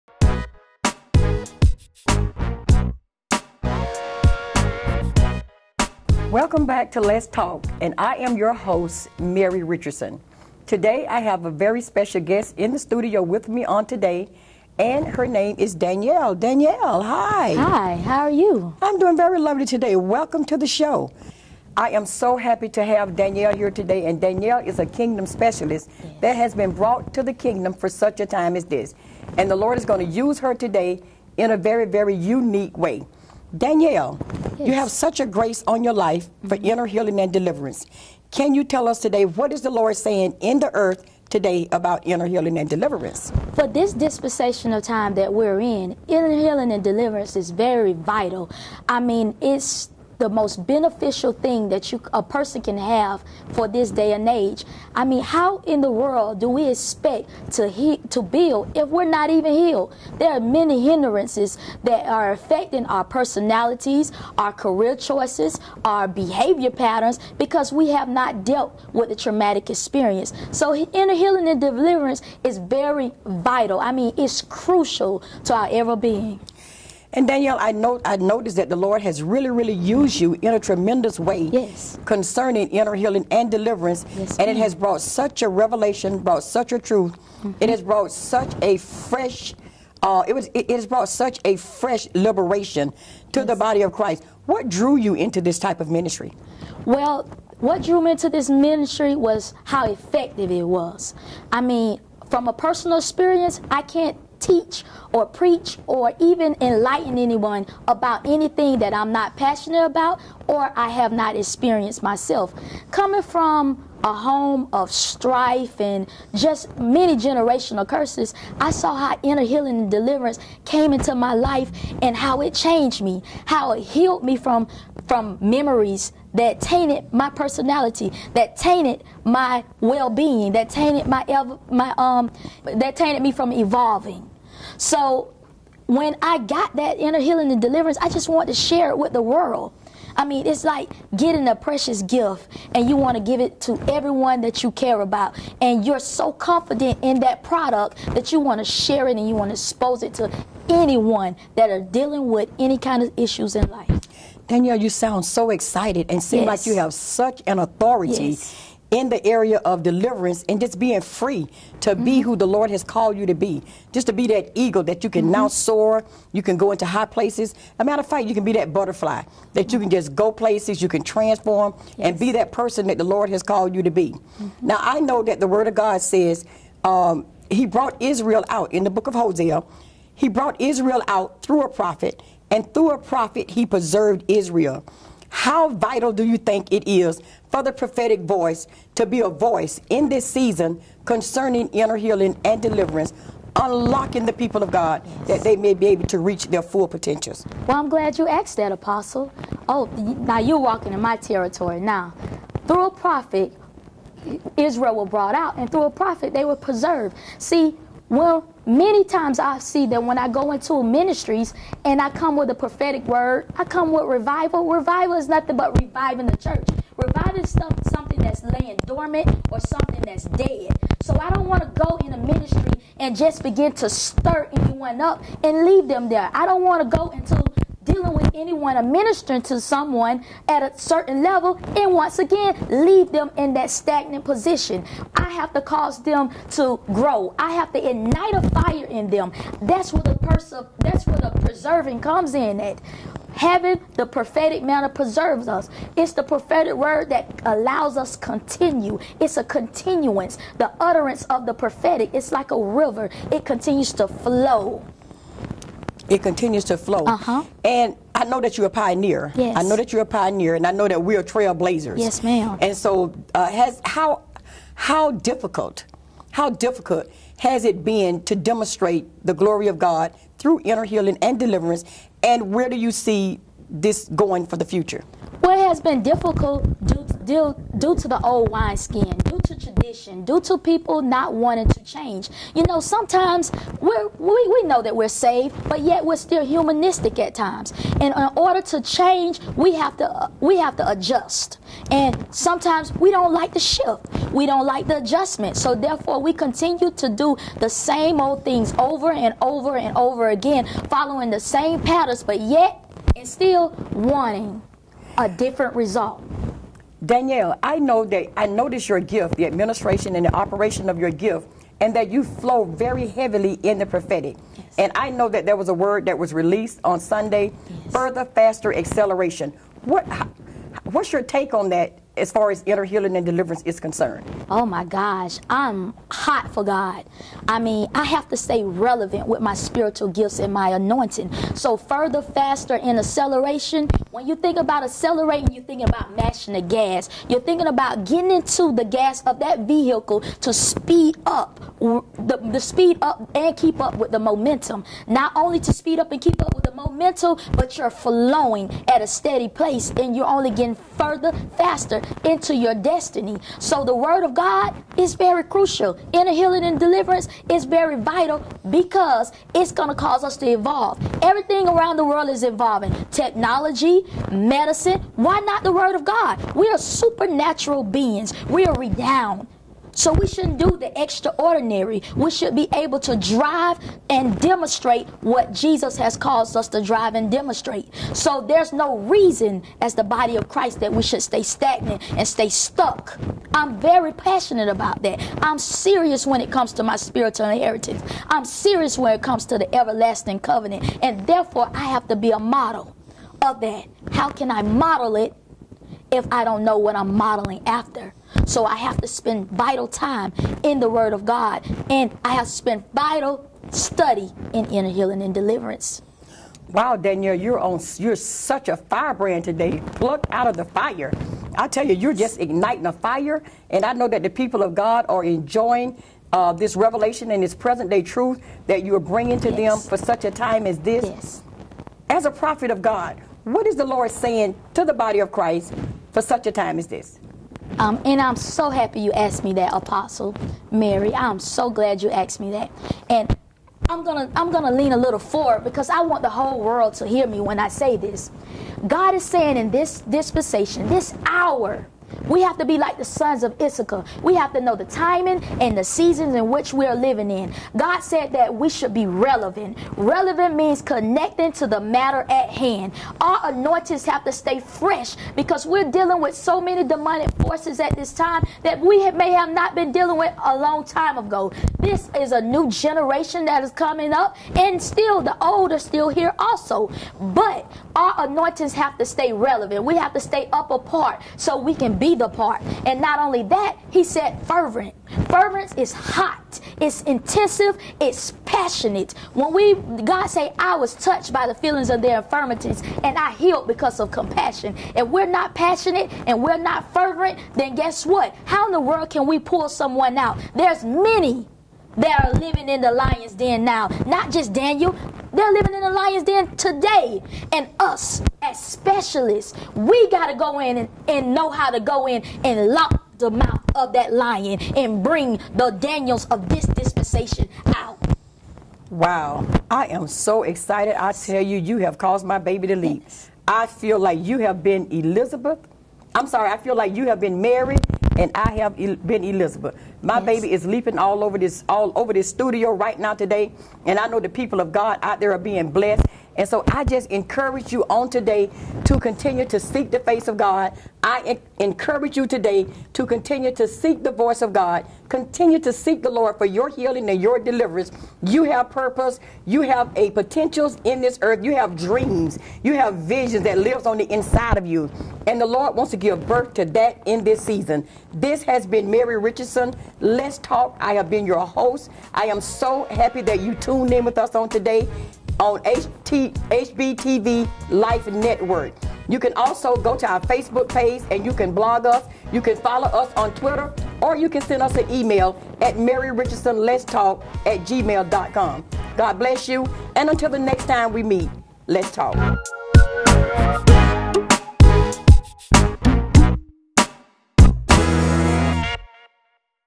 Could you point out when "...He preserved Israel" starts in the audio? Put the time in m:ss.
3:03.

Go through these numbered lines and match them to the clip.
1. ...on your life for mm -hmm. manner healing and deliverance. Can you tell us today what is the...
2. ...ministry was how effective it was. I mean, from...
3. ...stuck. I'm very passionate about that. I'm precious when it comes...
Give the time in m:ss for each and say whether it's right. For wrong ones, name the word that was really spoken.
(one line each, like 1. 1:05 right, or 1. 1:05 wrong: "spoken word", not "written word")
1. 0:35 wrong: "inner", not "manner"
2. 1:38 right
3. 6:22 wrong: "serious", not "precious".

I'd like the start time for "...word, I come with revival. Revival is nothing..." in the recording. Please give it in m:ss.
3:33.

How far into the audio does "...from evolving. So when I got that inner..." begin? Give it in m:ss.
2:13.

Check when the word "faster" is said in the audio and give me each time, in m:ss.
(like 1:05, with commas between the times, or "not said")
5:18, 5:32, 5:51.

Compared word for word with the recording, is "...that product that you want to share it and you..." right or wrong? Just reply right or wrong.
right.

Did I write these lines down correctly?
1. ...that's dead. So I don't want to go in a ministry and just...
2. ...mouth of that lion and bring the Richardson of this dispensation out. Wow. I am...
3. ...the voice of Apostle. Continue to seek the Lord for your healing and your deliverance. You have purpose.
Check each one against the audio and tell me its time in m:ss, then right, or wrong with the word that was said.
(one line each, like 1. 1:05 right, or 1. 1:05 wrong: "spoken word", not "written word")
1. 3:40 right
2. 8:23 wrong: "Daniels", not "Richardson"
3. 8:54 wrong: "God", not "Apostle".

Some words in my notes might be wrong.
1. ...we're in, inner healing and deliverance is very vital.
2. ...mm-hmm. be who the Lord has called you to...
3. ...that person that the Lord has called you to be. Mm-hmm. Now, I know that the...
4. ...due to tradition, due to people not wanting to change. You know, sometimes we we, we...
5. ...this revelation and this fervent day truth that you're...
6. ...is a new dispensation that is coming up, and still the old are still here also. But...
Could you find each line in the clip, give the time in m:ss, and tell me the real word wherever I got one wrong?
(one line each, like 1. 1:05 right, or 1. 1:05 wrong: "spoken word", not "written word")
1. 0:45 right
2. 2:41 right
3. 2:52 right
4. 4:39 right
5. 6:56 wrong: "present", not "fervent"
6. 7:42 wrong: "generation", not "dispensation".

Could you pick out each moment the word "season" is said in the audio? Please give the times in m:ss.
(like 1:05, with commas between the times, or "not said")
3:10, 7:25, 9:07.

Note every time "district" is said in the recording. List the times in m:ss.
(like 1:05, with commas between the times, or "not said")
not said.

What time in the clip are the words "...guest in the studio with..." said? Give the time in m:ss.
0:12.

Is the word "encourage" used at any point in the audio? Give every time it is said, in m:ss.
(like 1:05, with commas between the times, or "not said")
8:47, 8:51.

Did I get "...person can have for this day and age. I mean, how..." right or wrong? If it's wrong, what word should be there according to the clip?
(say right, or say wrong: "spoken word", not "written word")
right.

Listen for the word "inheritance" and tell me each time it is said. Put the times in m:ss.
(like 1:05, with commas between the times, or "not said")
6:27.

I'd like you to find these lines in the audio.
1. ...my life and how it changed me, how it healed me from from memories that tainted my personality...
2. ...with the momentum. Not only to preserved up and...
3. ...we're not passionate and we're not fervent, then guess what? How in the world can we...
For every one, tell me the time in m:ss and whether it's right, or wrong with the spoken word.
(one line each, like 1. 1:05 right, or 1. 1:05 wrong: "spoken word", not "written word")
1. 2:01 right
2. 5:43 wrong: "speed", not "preserved"
3. 8:05 right.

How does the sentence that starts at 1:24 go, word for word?
Yes, and it has brought such a revelation, brought such a truth.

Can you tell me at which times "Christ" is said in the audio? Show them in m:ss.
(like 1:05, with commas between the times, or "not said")
1:33, 6:20, 7:05.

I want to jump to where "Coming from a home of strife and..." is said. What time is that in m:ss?
1:52.